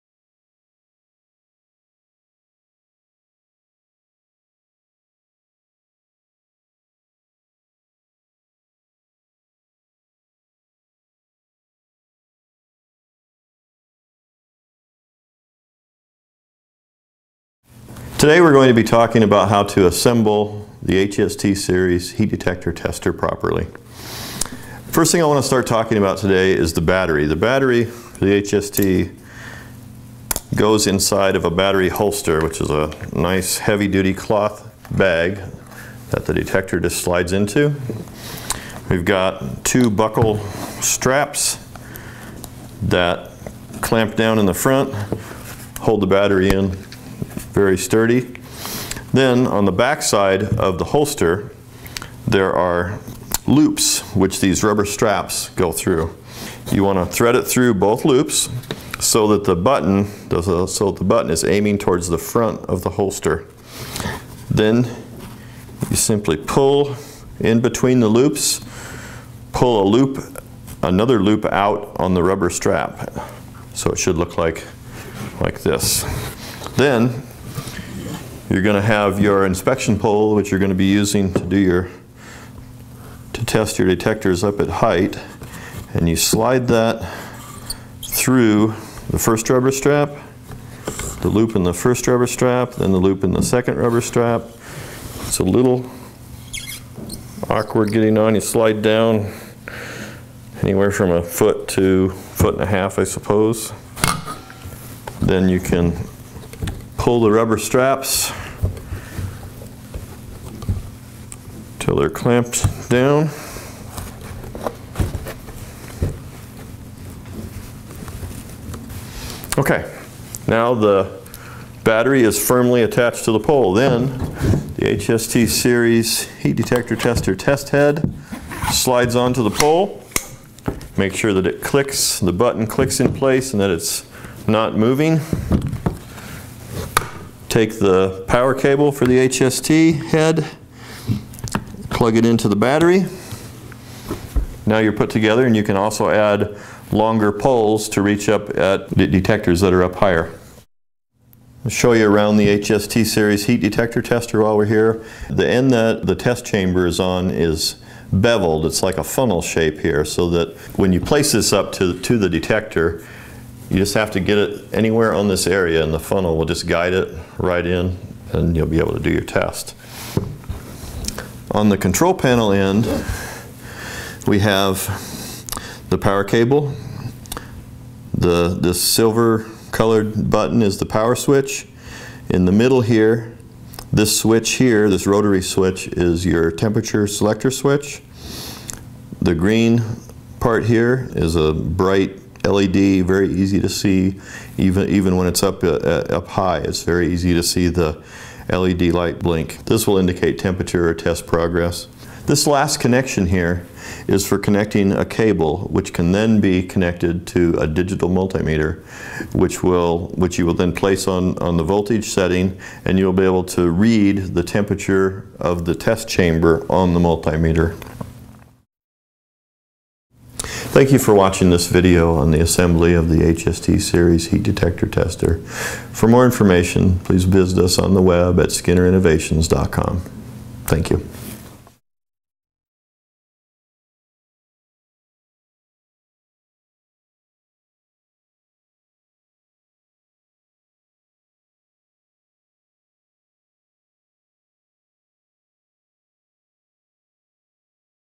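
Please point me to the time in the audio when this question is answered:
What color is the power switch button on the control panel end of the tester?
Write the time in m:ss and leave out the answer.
2:58.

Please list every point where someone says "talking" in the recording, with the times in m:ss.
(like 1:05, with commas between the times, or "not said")
0:18, 0:25.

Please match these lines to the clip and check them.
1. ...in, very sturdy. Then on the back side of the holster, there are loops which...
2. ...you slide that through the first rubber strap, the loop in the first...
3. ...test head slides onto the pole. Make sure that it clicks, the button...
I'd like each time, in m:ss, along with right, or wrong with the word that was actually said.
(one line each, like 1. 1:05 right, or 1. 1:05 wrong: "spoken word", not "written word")
1. 0:46 right
2. 1:26 right
3. 2:07 right.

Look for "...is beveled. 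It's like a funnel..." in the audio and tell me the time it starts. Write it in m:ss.
2:37.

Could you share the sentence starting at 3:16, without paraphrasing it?
It's very easy to see the LED light blink.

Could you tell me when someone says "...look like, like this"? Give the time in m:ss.
1:14.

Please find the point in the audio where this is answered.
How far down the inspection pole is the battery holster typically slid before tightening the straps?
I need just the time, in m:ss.
1:41.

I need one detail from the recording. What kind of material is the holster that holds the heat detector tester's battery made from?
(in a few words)
heavy duty cloth.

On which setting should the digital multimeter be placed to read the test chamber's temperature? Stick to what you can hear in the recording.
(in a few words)
voltage.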